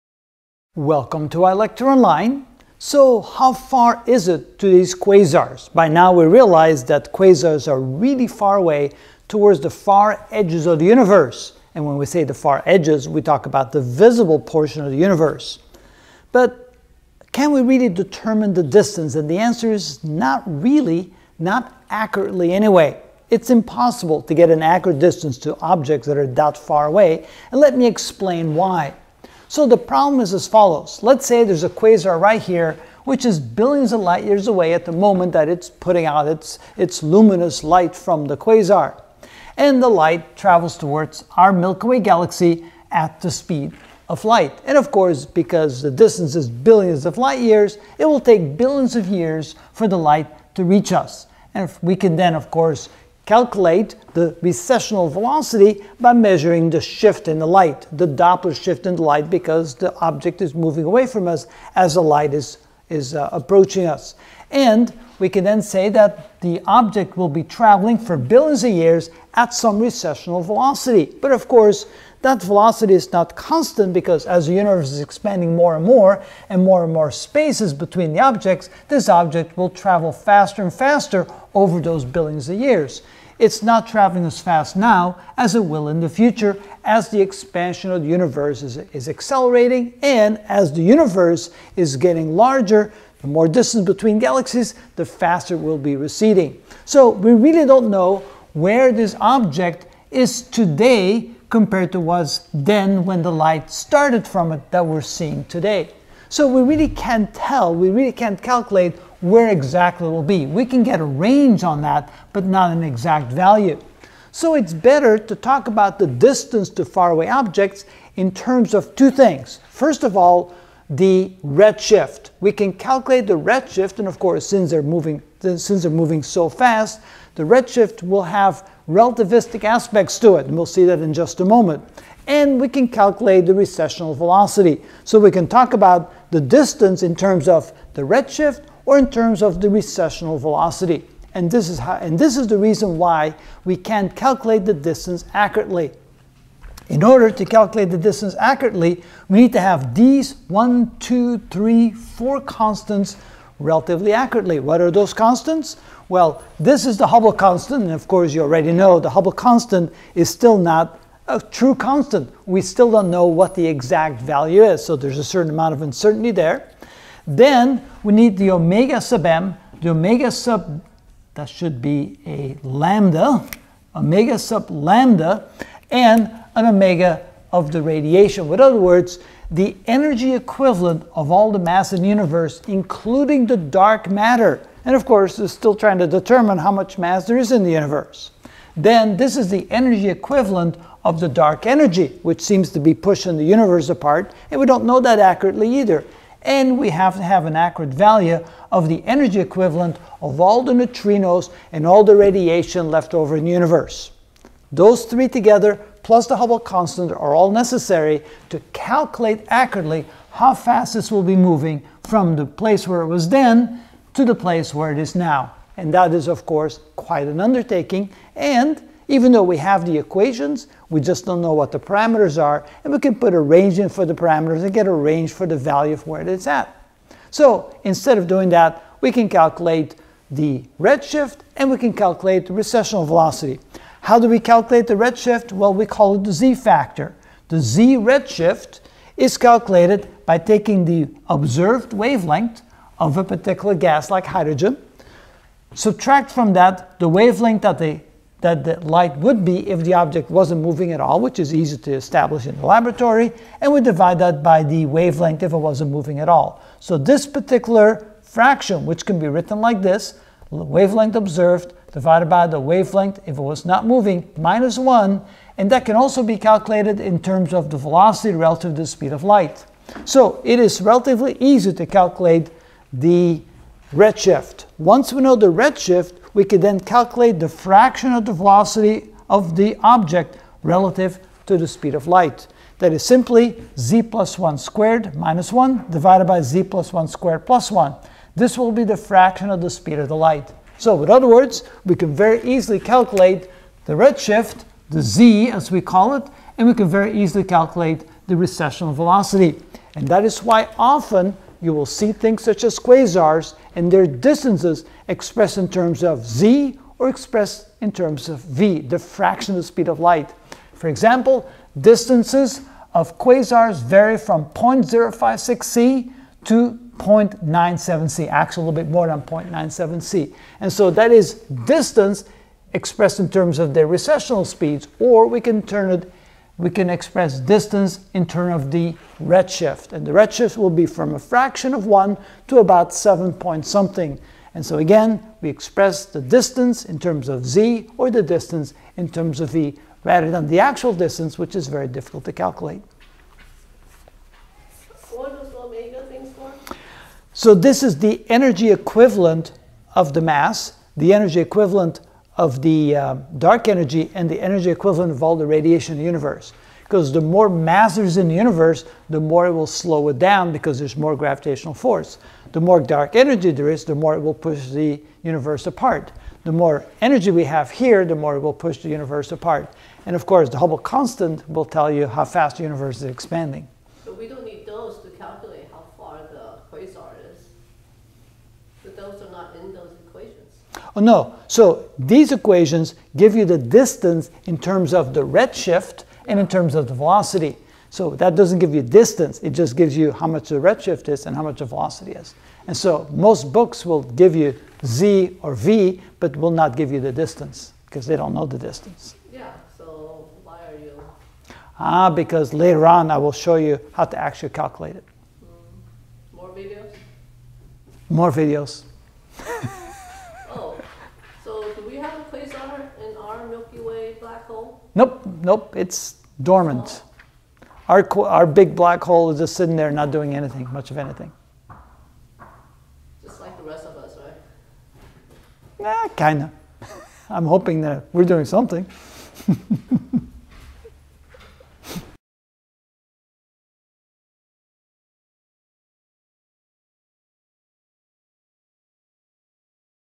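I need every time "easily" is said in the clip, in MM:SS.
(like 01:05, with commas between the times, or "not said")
04:52, 04:57.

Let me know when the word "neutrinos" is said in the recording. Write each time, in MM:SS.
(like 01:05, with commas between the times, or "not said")
03:20.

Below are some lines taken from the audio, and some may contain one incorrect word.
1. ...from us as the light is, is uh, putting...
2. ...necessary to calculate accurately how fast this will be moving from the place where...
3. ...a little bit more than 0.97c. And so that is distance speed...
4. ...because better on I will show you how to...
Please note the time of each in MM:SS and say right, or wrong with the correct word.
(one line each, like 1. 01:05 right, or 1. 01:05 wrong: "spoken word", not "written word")
1. 01:01 wrong: "approaching", not "putting"
2. 03:27 right
3. 05:18 wrong: "expressed", not "speed"
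4. 06:42 wrong: "later", not "better".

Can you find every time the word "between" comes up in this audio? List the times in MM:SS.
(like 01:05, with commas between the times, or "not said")
01:17, 01:33.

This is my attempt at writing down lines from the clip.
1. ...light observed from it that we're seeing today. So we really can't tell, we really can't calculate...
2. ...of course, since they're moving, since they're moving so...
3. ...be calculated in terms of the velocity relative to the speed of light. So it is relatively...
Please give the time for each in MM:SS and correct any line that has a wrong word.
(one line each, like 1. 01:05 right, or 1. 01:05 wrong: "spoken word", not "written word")
1. 01:43 wrong: "started", not "observed"
2. 02:04 right
3. 04:26 right.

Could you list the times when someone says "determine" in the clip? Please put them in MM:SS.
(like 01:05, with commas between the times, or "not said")
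00:17, 03:06.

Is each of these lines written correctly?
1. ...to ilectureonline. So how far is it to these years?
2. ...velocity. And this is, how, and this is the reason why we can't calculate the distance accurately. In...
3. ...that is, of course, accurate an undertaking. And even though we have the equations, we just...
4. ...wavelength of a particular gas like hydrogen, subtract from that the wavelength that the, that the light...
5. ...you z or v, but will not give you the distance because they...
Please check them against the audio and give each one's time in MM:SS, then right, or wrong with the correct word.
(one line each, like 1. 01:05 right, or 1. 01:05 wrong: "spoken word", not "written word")
1. 00:01 wrong: "quasars", not "years"
2. 02:20 right
3. 03:35 wrong: "quite", not "accurate"
4. 04:01 right
5. 06:34 right.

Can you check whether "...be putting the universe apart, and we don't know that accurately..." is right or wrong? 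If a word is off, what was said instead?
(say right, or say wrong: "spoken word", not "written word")
wrong: "pushing", not "putting".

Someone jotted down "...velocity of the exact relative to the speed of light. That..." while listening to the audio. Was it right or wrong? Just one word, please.
wrong.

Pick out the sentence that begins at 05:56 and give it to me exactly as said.
Because the more mass there's in the universe, the more it will slow it down because there's more gravitational force.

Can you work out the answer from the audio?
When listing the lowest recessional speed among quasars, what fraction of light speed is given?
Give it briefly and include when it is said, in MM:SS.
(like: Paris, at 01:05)
0.056c, at 05:14.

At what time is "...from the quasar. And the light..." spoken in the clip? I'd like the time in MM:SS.
00:37.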